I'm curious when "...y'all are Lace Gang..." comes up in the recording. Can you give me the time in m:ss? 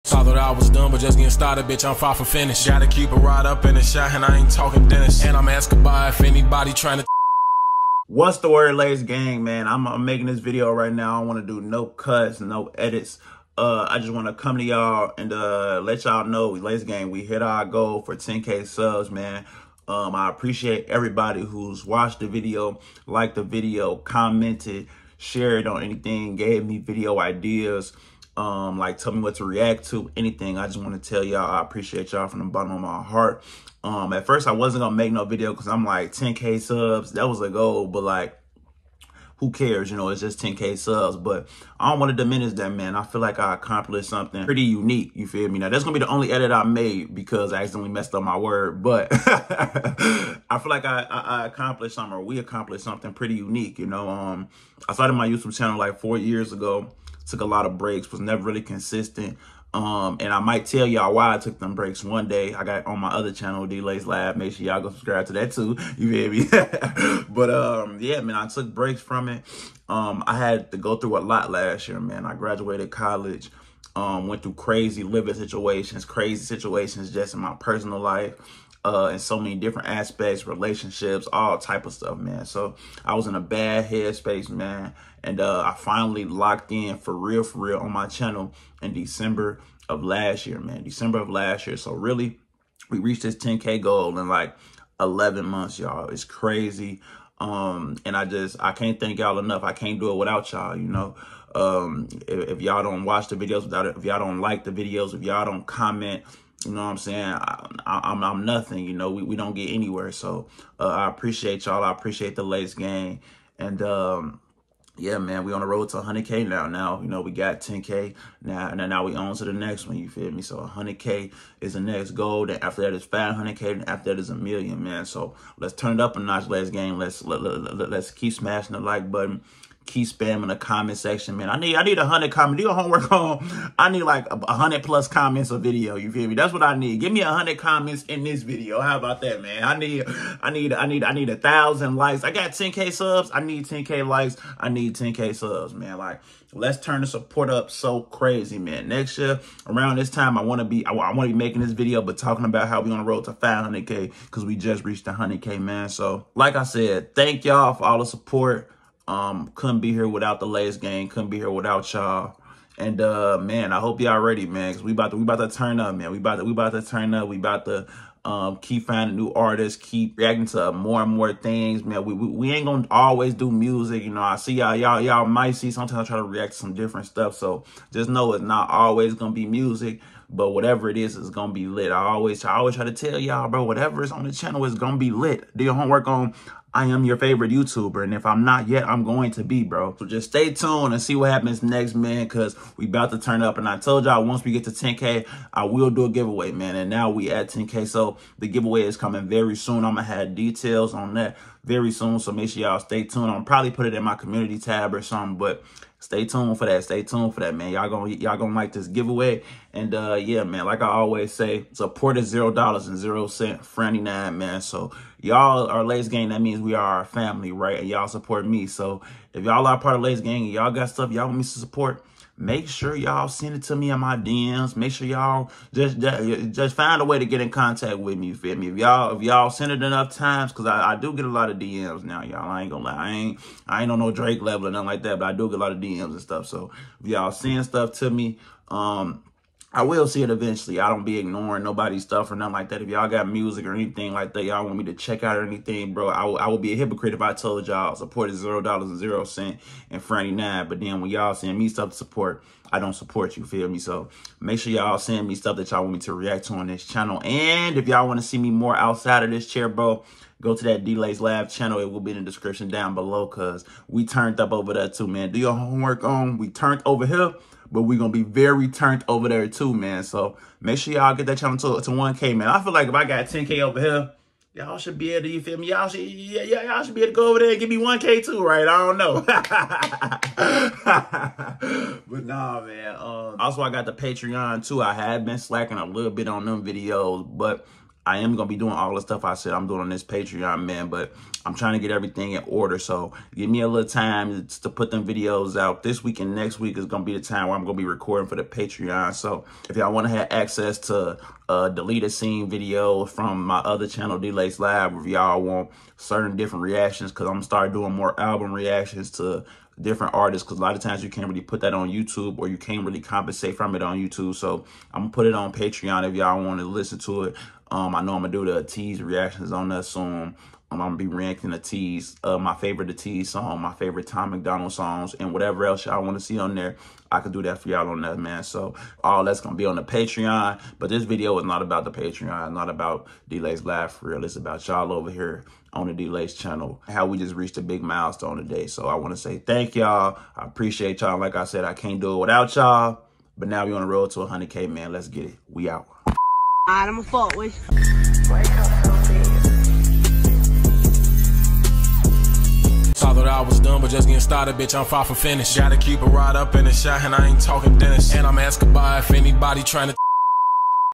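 3:35.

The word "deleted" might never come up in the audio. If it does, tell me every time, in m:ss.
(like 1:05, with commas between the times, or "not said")
5:01.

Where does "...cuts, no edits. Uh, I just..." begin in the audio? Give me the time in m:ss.
0:11.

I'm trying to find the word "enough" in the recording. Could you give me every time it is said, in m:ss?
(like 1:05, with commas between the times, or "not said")
1:39, 3:49.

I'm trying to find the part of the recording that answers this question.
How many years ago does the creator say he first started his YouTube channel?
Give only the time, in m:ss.
0:55.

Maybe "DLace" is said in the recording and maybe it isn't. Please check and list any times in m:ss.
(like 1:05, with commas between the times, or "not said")
1:03, 4:20, 5:36.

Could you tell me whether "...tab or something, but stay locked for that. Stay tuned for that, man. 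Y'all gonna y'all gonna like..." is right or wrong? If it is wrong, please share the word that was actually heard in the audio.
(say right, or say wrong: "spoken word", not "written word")
wrong: "tuned", not "locked".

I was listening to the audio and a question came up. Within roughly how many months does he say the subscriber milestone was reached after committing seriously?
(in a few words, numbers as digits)
11.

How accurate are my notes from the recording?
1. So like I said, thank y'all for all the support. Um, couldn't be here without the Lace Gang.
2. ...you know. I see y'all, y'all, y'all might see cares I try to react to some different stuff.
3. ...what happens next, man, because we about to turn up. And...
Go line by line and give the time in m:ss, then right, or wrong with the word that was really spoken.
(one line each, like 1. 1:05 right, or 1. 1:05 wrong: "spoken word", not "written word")
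1. 2:35 right
2. 2:54 wrong: "sometimes", not "cares"
3. 3:11 right.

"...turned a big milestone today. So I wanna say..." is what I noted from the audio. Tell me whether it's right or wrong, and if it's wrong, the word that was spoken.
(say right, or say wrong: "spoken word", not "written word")
wrong: "reached", not "turned".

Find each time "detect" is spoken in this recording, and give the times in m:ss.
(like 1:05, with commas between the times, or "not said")
not said.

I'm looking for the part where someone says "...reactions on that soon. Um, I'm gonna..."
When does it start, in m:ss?
5:19.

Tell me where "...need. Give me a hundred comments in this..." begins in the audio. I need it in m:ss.
2:16.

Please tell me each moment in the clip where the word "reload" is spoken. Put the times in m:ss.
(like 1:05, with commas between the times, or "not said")
not said.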